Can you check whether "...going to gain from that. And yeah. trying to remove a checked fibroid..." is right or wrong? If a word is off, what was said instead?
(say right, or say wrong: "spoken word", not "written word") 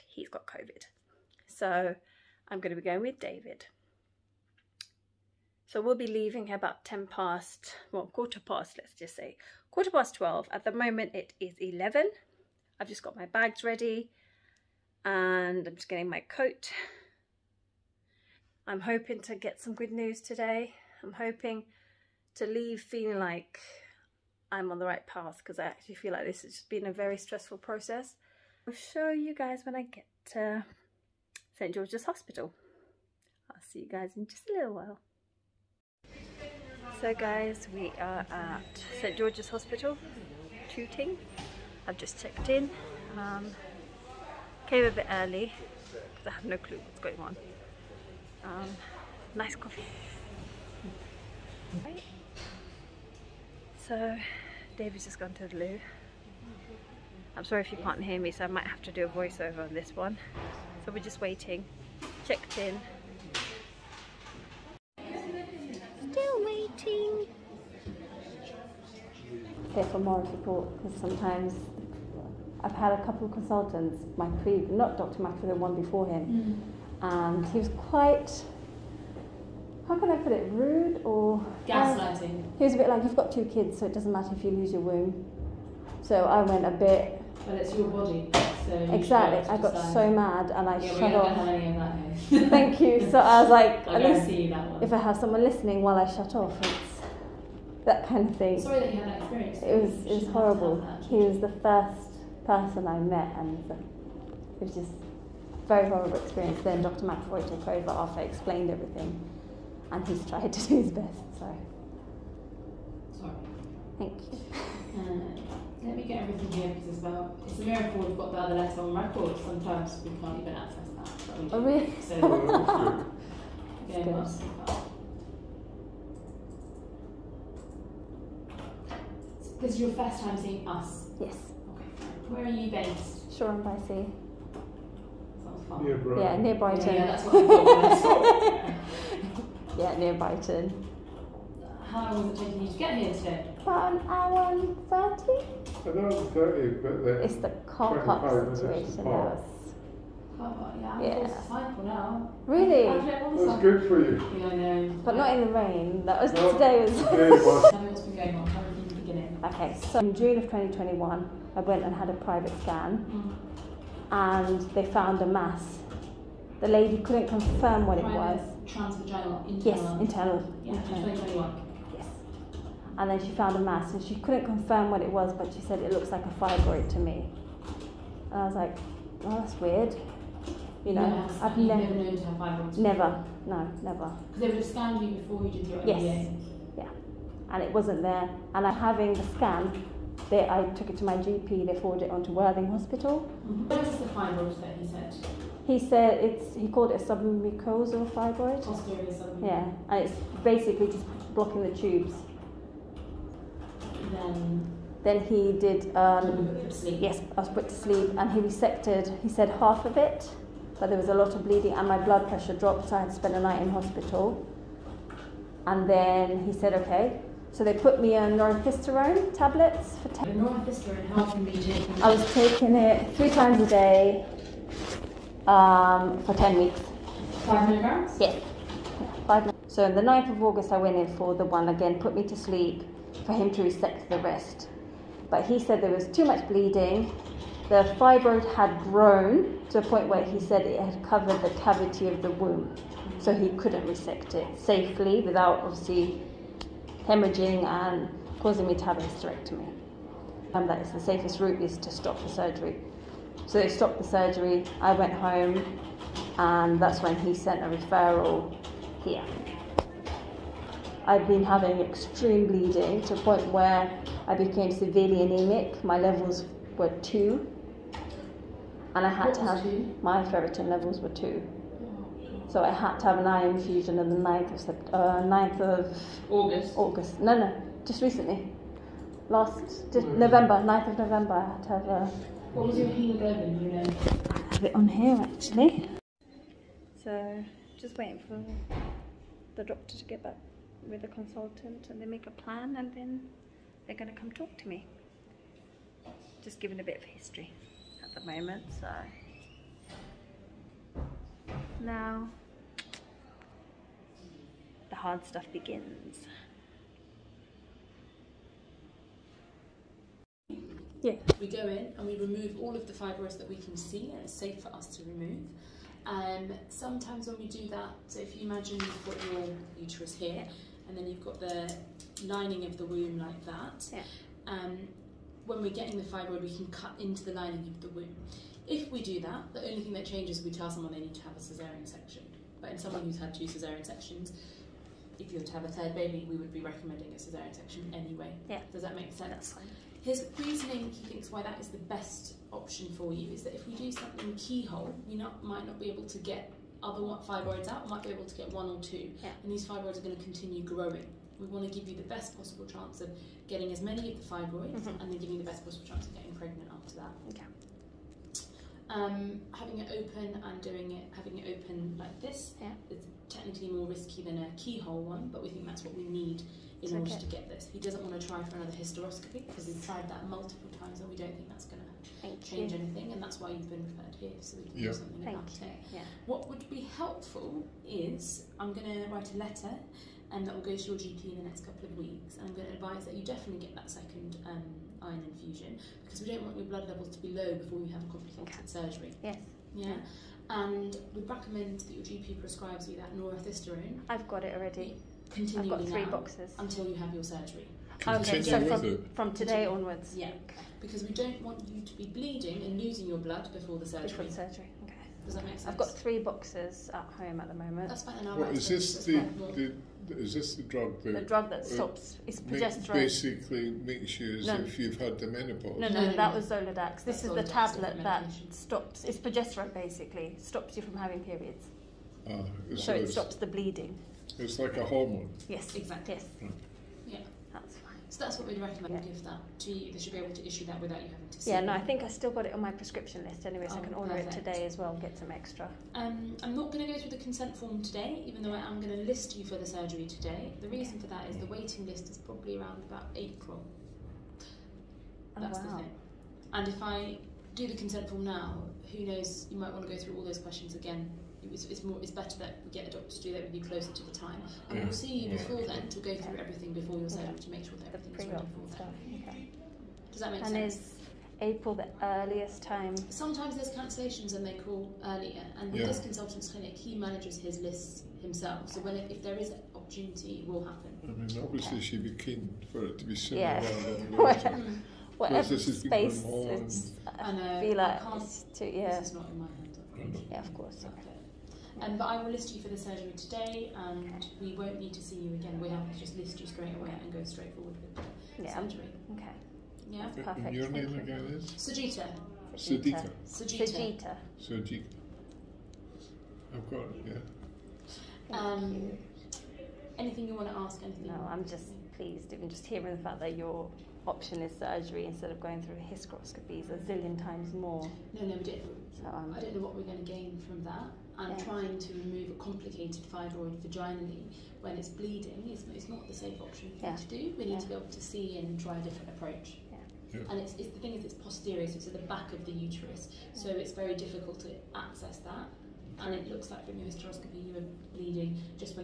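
wrong: "complicated", not "checked".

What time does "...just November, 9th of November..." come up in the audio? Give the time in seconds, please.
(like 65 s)
279 s.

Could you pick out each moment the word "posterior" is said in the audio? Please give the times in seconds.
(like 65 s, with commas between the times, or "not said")
521 s.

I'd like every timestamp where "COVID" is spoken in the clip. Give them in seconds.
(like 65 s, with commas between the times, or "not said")
0 s.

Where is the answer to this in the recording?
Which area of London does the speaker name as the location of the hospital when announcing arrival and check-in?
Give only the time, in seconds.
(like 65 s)
40 s.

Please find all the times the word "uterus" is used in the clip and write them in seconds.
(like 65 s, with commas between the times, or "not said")
319 s, 522 s.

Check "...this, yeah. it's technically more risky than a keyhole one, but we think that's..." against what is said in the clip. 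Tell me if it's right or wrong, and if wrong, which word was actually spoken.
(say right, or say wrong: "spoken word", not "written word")
right.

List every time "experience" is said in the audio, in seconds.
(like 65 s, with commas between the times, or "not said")
99 s, 106 s.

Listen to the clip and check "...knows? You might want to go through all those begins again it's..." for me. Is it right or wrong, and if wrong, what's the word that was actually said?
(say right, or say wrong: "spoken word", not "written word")
wrong: "questions", not "begins".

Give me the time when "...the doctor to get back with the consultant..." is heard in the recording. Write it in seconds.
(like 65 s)
289 s.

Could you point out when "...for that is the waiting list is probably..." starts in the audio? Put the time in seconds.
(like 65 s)
440 s.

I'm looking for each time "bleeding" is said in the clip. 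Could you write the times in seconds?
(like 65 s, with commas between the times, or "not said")
211 s, 236 s, 262 s, 402 s, 423 s, 514 s, 527 s.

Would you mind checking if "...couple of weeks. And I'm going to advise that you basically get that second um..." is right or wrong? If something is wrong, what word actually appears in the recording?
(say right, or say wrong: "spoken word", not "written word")
wrong: "definitely", not "basically".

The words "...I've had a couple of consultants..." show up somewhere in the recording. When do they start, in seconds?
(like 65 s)
72 s.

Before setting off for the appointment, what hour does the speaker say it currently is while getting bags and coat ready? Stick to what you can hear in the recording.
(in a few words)
11.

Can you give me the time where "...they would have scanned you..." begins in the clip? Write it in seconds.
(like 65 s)
184 s.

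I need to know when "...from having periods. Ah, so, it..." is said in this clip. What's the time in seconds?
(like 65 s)
420 s.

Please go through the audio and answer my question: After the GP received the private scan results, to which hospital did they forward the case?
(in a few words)
Worthing Hospital.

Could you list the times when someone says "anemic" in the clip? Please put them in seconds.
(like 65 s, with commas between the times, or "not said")
265 s.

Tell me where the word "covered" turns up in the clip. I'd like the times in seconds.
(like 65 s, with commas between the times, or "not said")
241 s.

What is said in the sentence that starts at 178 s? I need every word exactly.
And I was like, well, oh, that's weird.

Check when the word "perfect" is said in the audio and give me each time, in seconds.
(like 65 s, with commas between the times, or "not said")
434 s, 490 s.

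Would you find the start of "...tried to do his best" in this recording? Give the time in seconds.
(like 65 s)
110 s.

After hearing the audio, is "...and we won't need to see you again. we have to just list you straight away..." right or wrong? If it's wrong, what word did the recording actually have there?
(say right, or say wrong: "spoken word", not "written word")
right.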